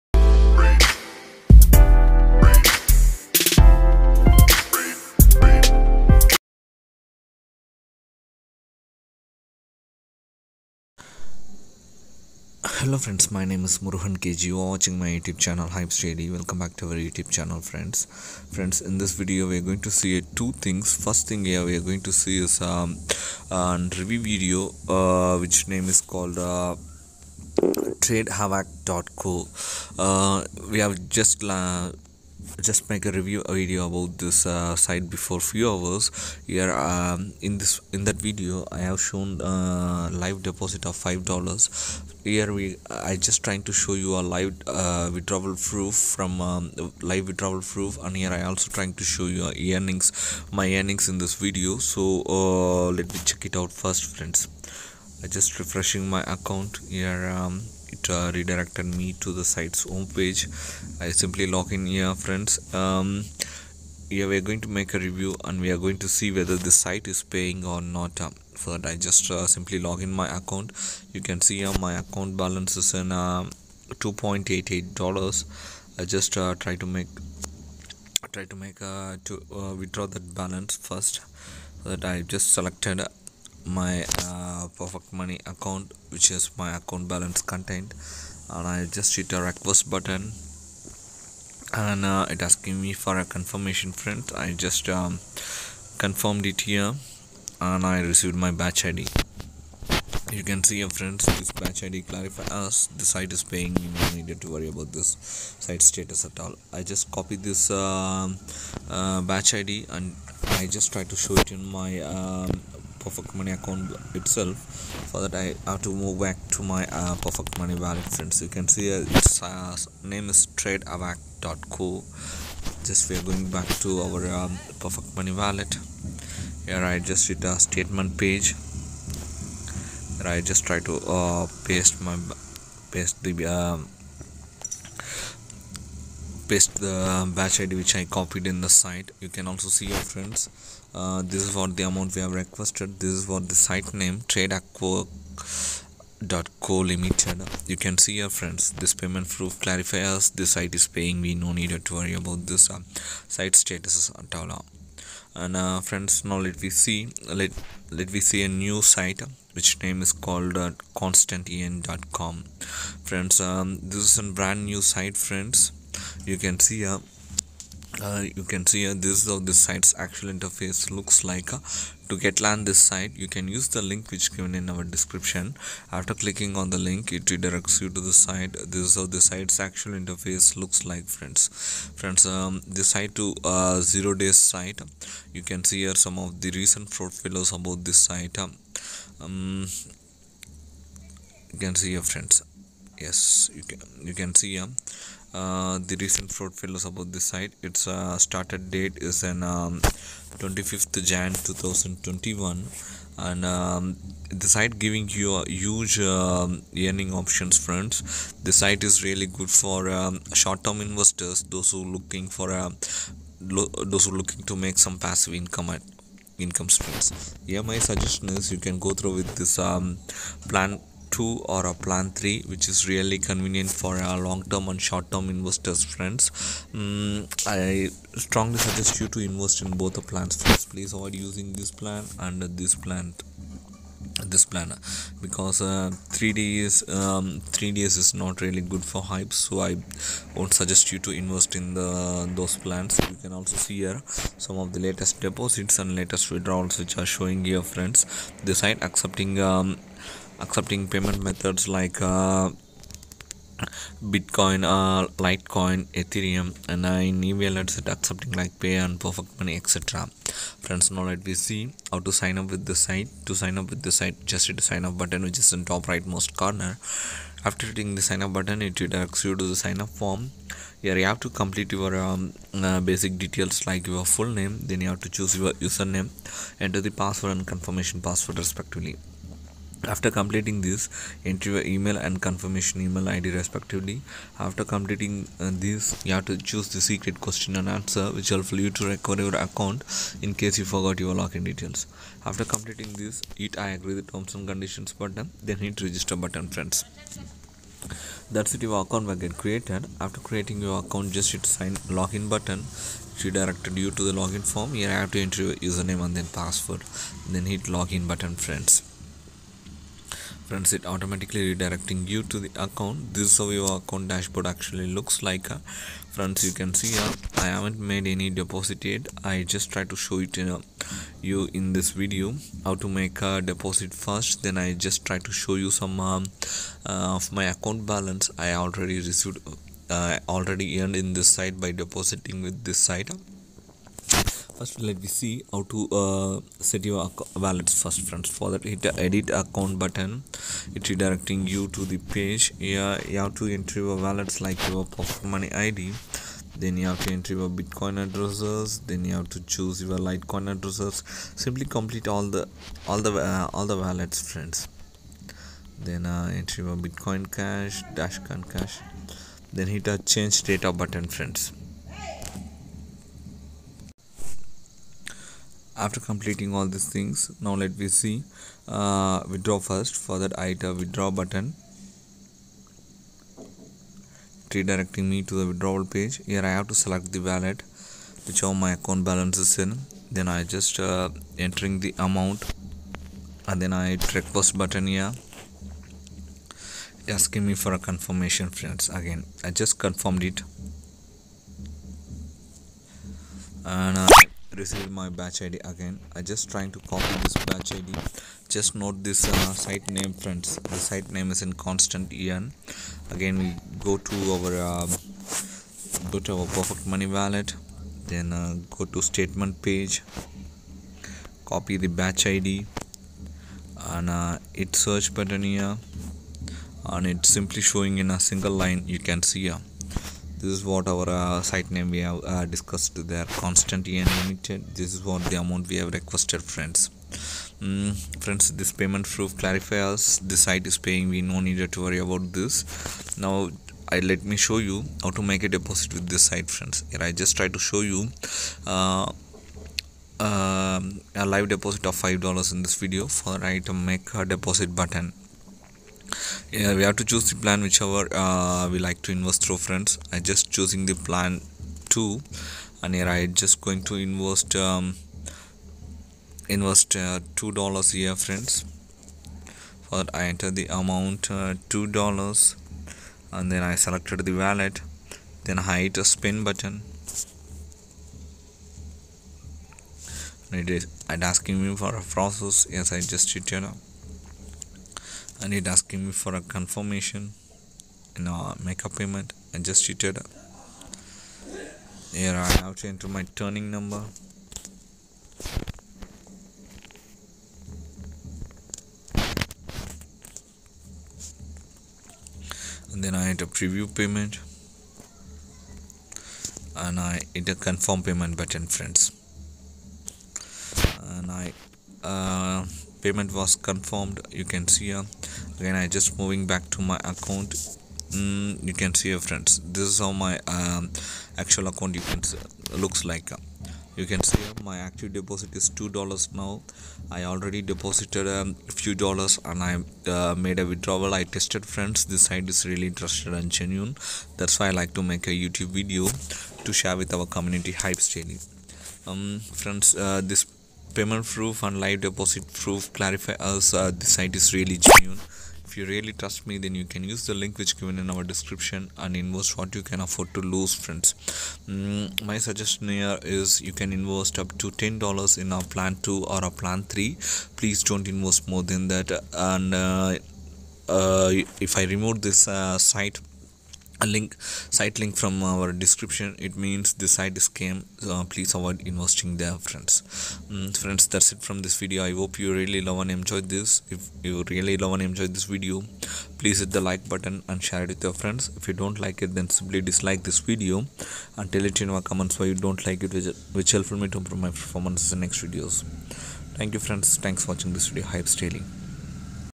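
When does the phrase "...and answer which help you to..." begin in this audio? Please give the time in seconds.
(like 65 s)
287 s.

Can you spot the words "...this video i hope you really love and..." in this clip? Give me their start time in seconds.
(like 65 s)
561 s.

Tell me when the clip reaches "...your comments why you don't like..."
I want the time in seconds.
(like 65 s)
571 s.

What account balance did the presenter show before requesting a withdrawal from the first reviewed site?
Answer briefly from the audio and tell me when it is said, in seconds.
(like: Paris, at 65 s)
$2.88, at 73 s.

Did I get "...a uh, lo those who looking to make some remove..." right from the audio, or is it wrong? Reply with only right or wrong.
wrong.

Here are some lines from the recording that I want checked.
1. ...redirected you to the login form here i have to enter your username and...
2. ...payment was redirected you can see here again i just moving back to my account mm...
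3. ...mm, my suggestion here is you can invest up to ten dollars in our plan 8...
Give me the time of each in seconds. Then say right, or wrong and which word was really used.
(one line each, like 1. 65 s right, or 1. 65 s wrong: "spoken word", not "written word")
1. 303 s right
2. 503 s wrong: "confirmed", not "redirected"
3. 541 s wrong: "2", not "8".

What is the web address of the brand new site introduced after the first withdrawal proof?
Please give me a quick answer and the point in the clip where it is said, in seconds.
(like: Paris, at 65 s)
constantearn.com, at 160 s.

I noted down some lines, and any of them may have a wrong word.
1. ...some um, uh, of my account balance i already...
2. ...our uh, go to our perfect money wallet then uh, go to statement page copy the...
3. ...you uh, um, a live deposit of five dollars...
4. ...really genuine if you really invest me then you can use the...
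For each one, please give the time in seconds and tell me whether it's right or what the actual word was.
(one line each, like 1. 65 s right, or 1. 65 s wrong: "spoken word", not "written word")
1. 325 s right
2. 404 s right
3. 437 s right
4. 534 s wrong: "trust", not "invest".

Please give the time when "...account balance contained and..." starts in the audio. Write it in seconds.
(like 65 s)
86 s.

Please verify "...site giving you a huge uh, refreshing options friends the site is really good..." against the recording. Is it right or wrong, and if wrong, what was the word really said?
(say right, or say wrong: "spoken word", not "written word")
wrong: "earning", not "refreshing".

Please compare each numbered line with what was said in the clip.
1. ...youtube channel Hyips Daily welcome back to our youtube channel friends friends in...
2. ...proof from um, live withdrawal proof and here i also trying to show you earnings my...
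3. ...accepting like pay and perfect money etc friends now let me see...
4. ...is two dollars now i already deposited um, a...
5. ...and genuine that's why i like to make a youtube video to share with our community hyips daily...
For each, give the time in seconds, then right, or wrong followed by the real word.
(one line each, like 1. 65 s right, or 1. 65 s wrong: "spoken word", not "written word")
1. 15 s right
2. 45 s right
3. 257 s right
4. 515 s right
5. 523 s right.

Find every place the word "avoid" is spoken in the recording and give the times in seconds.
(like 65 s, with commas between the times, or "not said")
230 s, 558 s.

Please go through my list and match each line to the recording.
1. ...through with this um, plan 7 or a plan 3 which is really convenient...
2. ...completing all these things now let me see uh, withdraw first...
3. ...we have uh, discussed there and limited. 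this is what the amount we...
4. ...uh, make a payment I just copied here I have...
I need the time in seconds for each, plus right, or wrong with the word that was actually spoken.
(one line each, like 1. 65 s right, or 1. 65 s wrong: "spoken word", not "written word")
1. 218 s wrong: "2", not "7"
2. 365 s right
3. 421 s right
4. 478 s wrong: "cheated", not "copied".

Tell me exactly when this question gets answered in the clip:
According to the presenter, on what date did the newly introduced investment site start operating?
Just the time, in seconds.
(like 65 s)
200 s.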